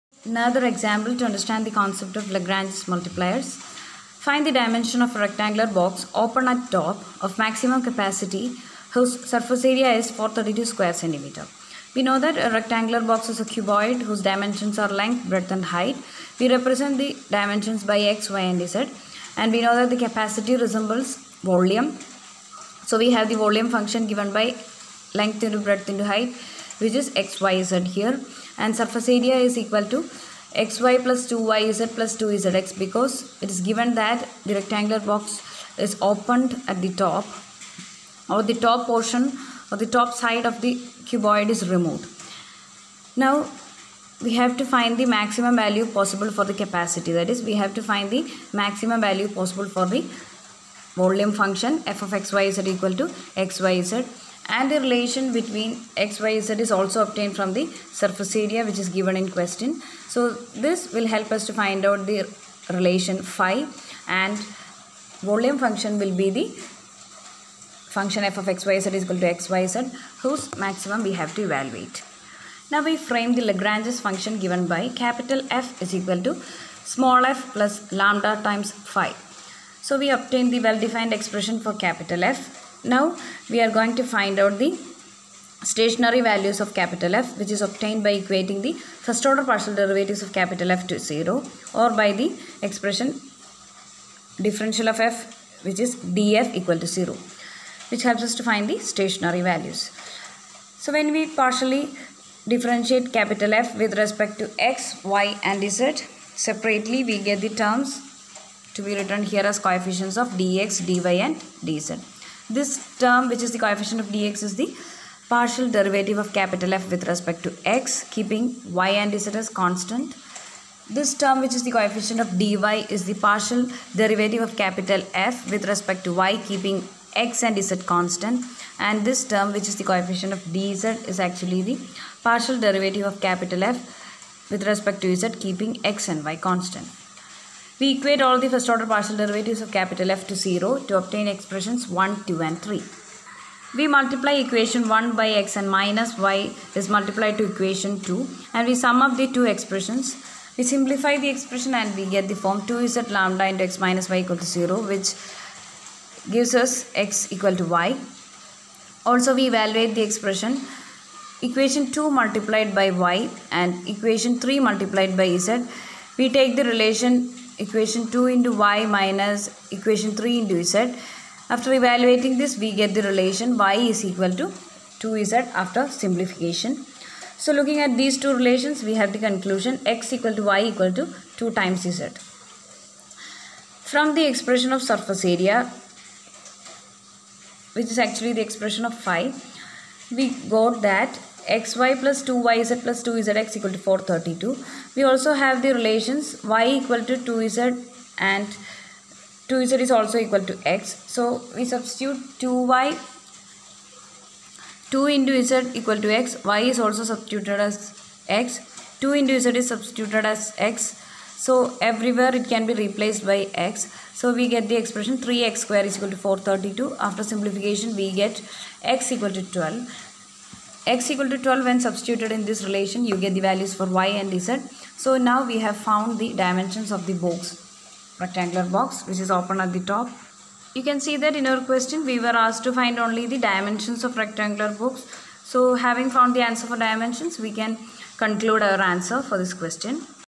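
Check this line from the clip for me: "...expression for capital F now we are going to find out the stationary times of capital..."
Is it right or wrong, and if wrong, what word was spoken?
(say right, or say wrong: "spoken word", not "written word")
wrong: "values", not "times".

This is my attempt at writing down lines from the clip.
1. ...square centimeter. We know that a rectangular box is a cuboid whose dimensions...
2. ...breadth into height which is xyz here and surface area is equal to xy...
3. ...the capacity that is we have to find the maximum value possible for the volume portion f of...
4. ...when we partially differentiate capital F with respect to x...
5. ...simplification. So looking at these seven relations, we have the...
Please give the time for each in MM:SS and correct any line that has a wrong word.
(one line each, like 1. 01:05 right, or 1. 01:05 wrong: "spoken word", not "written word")
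1. 00:10 right
2. 00:25 right
3. 00:46 wrong: "function", not "portion"
4. 01:40 right
5. 02:56 wrong: "two", not "seven".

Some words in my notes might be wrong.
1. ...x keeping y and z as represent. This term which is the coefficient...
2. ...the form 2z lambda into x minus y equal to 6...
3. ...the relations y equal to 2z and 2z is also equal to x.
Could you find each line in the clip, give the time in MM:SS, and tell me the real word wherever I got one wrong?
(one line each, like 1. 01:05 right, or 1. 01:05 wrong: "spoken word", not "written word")
1. 01:57 wrong: "constant", not "represent"
2. 02:32 wrong: "0", not "6"
3. 03:15 right.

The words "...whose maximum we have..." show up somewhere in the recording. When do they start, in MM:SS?
01:10.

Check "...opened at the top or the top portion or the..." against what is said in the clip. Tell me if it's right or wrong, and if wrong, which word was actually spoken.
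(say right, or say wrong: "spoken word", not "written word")
right.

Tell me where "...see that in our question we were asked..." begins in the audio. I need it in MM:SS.
03:50.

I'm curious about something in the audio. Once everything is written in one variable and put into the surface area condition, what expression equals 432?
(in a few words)
3x square.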